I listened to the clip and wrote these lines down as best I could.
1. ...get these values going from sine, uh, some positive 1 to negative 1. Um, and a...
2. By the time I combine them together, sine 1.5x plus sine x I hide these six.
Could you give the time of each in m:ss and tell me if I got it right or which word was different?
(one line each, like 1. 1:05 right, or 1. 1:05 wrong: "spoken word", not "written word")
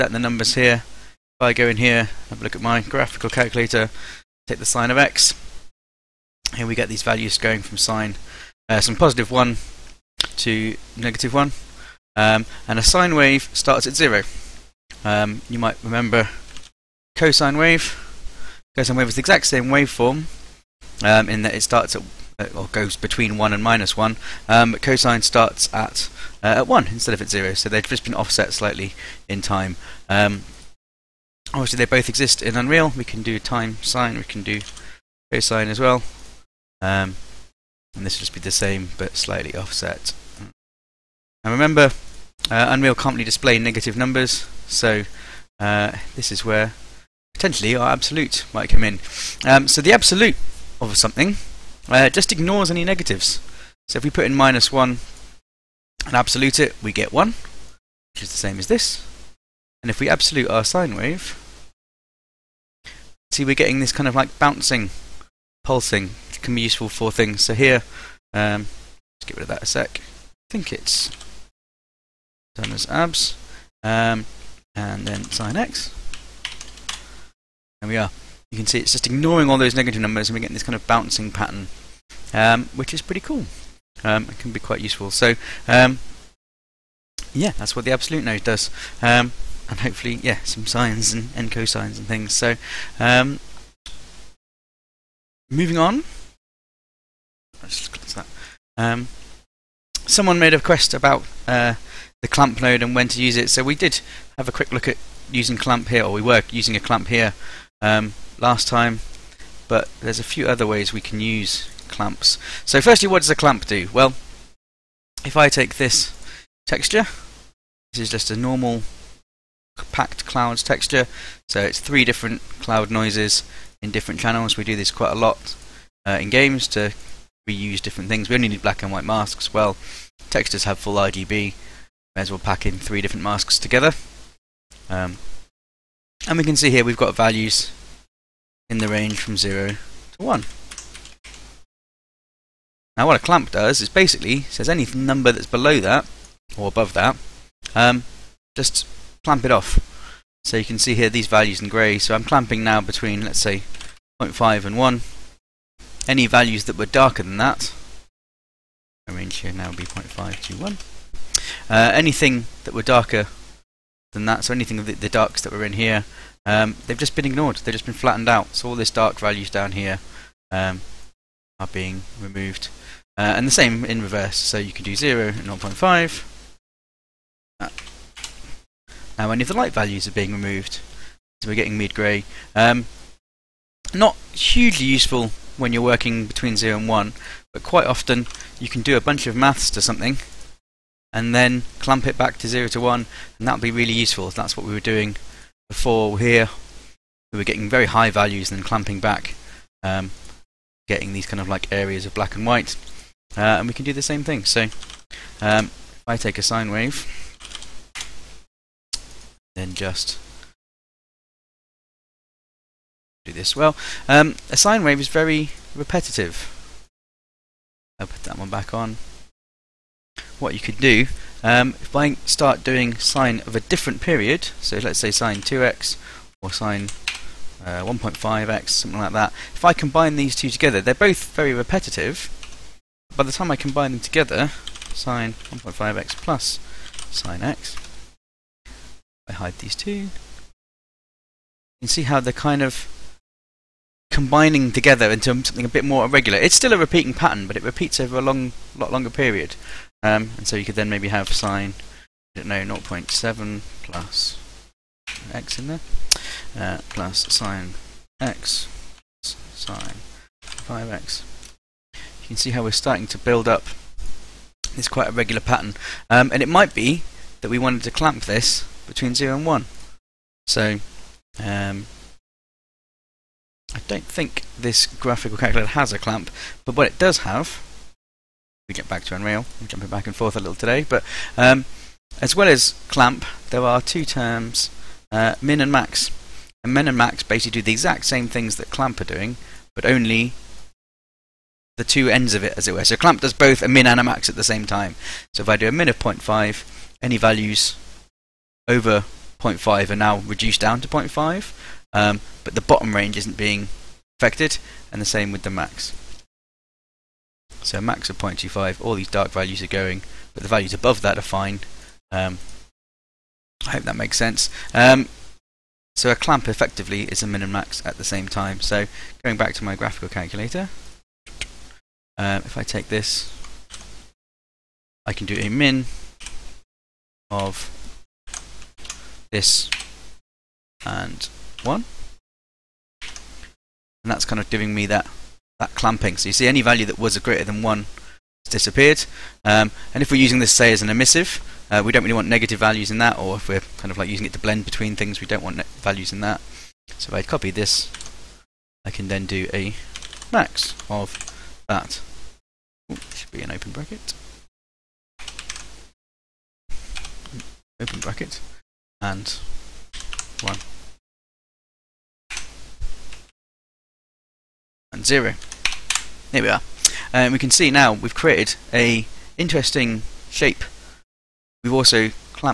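1. 0:06 right
2. 3:53 wrong: "two", not "six".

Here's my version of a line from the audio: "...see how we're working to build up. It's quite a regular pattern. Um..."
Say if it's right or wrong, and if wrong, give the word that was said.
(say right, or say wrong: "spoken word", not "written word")
wrong: "starting", not "working".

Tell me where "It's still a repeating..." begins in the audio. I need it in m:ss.
4:06.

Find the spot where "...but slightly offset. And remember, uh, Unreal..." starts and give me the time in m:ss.
0:38.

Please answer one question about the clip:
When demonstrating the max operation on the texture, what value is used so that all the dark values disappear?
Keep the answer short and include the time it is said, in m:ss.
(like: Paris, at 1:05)
0.25, at 5:07.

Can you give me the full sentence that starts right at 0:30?
Um, obviously they both exist in Unreal.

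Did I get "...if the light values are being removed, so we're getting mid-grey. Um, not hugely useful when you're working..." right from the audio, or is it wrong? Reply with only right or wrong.
right.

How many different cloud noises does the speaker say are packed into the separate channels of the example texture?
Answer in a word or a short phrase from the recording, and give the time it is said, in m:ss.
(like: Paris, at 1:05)
3, at 2:01.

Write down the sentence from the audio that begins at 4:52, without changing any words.
So clamp does both a min and a max at the same time.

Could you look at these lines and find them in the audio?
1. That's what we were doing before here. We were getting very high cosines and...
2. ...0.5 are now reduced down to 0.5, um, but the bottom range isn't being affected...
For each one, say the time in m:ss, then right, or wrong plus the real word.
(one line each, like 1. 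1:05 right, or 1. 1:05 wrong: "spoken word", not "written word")
1. 3:14 wrong: "values", not "cosines"
2. 4:59 right.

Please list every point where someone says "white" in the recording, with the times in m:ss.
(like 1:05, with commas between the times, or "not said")
2:08, 3:22.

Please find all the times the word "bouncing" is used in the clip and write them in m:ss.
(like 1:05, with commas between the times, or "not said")
1:04, 1:20.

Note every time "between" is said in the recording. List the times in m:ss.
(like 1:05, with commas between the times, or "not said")
0:22, 2:32, 3:06, 4:28, 5:44.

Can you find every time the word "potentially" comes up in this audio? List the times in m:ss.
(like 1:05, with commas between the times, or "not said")
0:47.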